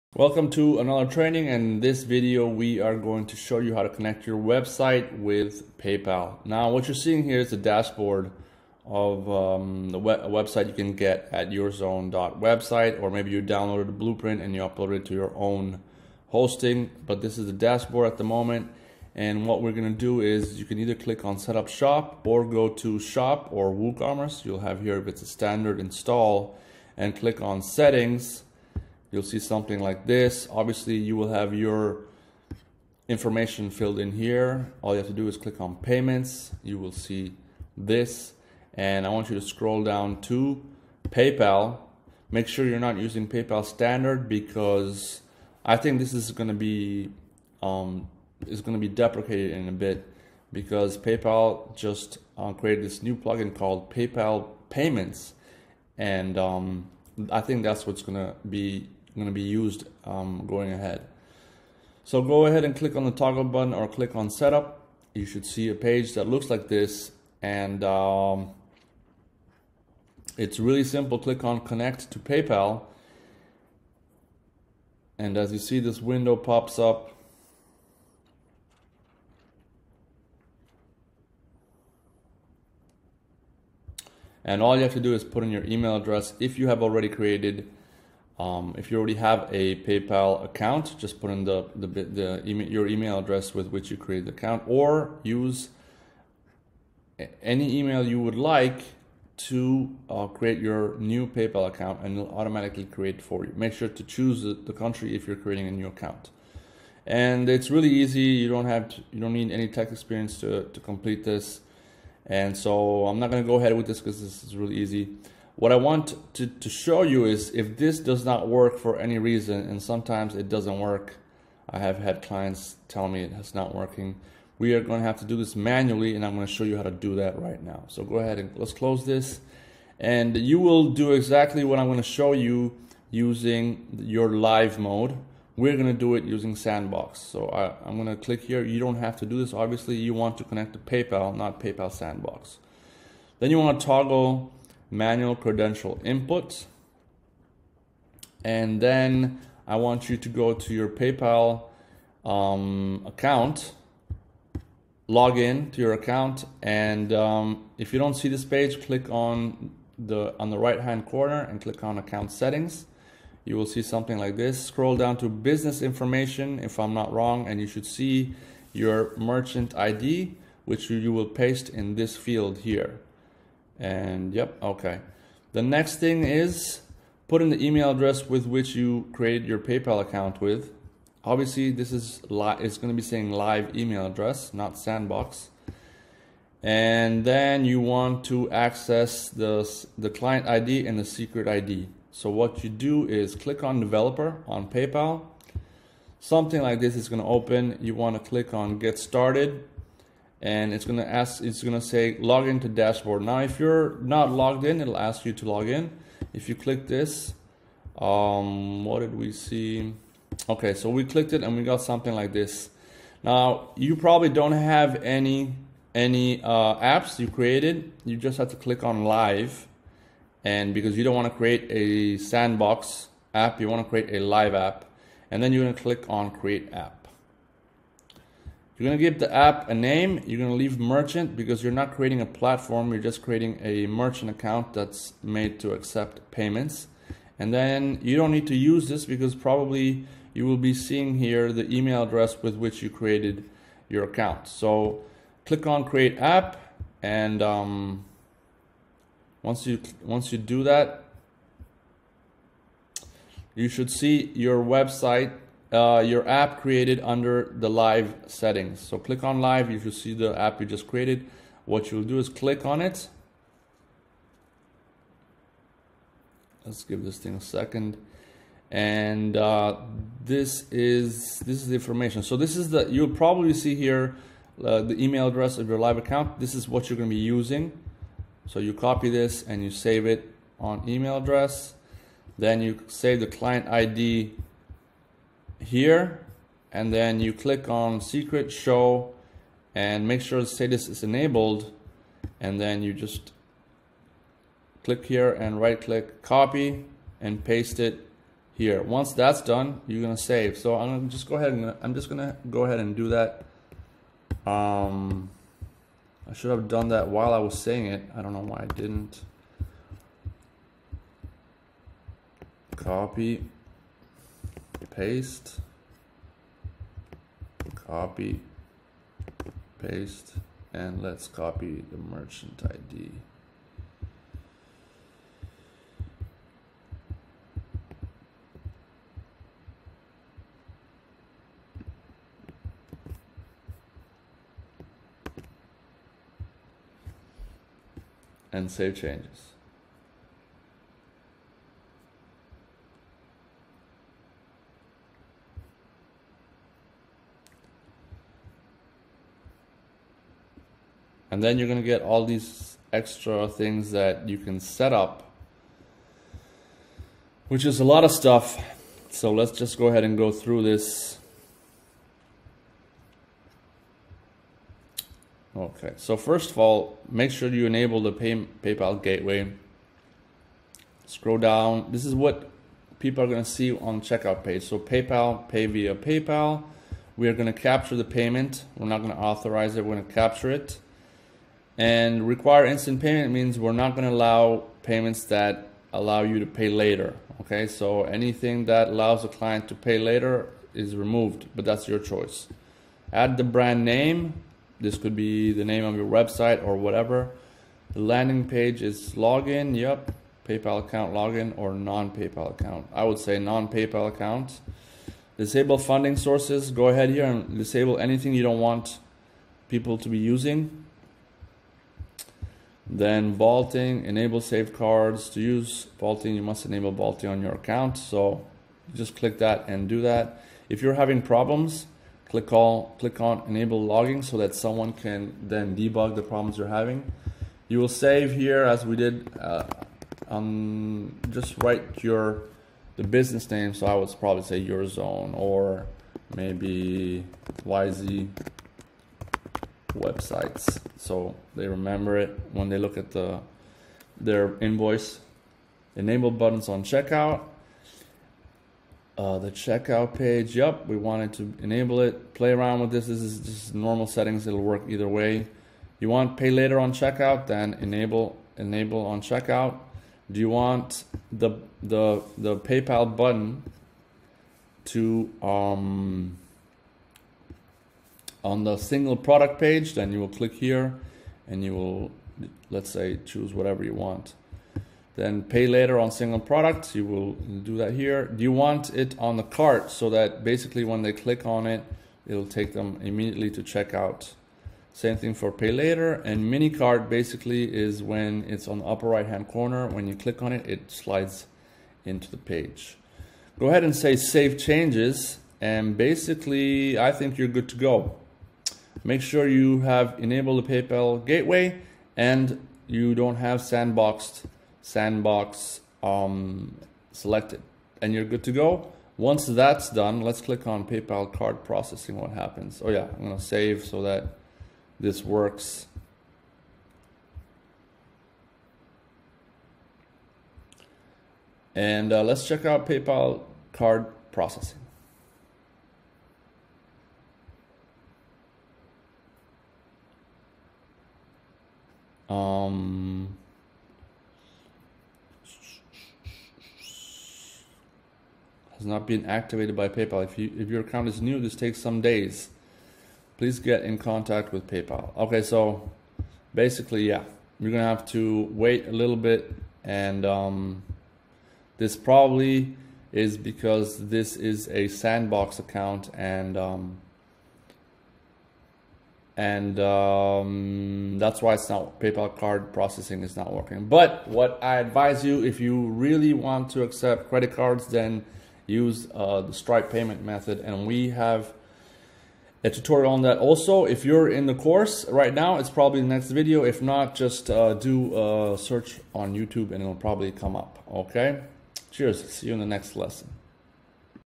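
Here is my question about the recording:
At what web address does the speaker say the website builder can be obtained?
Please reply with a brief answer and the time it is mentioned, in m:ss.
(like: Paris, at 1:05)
yourzone.website, at 0:11.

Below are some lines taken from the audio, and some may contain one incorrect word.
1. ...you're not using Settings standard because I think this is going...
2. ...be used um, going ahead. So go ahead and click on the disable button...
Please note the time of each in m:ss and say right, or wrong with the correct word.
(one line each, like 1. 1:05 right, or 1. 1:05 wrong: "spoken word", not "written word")
1. 0:42 wrong: "PayPal", not "Settings"
2. 0:59 wrong: "toggle", not "disable".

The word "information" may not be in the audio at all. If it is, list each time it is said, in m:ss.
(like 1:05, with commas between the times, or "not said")
0:33, 2:45, 4:31.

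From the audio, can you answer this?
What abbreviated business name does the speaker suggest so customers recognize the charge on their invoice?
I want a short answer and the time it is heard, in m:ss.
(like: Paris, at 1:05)
YZ websites, at 7:17.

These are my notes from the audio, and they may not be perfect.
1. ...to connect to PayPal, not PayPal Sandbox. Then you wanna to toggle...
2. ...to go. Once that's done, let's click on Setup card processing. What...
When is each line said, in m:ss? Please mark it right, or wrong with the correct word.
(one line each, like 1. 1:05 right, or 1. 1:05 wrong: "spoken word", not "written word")
1. 2:20 right
2. 8:28 wrong: "PayPal", not "Setup".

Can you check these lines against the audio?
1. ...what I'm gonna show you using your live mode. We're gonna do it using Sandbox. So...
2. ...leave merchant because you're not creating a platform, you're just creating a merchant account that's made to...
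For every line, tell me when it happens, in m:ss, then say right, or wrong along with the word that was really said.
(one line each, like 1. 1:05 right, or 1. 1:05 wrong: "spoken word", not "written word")
1. 2:11 right
2. 3:50 right.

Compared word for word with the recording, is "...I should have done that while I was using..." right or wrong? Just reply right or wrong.
wrong.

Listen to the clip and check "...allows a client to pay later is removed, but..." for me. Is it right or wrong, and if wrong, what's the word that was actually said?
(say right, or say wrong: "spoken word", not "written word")
right.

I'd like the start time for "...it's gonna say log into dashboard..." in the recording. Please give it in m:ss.
3:21.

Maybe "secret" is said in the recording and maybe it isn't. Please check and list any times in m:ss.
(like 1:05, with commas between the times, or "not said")
3:11, 4:48.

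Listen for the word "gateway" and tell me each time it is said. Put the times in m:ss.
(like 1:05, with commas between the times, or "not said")
6:09, 8:21.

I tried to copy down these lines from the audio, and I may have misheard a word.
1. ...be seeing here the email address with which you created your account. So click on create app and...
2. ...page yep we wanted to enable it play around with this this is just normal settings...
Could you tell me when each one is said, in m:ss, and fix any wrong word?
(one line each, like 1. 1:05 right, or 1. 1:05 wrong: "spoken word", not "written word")
1. 4:00 right
2. 7:30 right.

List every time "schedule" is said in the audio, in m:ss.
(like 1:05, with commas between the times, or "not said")
not said.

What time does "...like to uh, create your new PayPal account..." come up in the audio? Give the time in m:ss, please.
1:38.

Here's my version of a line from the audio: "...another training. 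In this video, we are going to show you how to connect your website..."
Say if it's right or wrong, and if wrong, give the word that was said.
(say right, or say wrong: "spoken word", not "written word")
right.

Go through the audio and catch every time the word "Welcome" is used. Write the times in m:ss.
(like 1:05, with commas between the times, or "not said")
0:00.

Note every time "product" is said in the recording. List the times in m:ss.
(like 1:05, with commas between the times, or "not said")
7:49, 7:56.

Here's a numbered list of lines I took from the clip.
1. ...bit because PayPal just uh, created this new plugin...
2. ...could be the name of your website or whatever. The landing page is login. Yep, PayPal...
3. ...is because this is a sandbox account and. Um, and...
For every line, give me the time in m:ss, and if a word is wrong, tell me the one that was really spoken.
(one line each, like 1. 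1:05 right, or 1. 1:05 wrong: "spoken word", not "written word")
1. 0:49 right
2. 6:34 right
3. 9:13 right.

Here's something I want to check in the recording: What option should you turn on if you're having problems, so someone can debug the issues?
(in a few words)
enable logging.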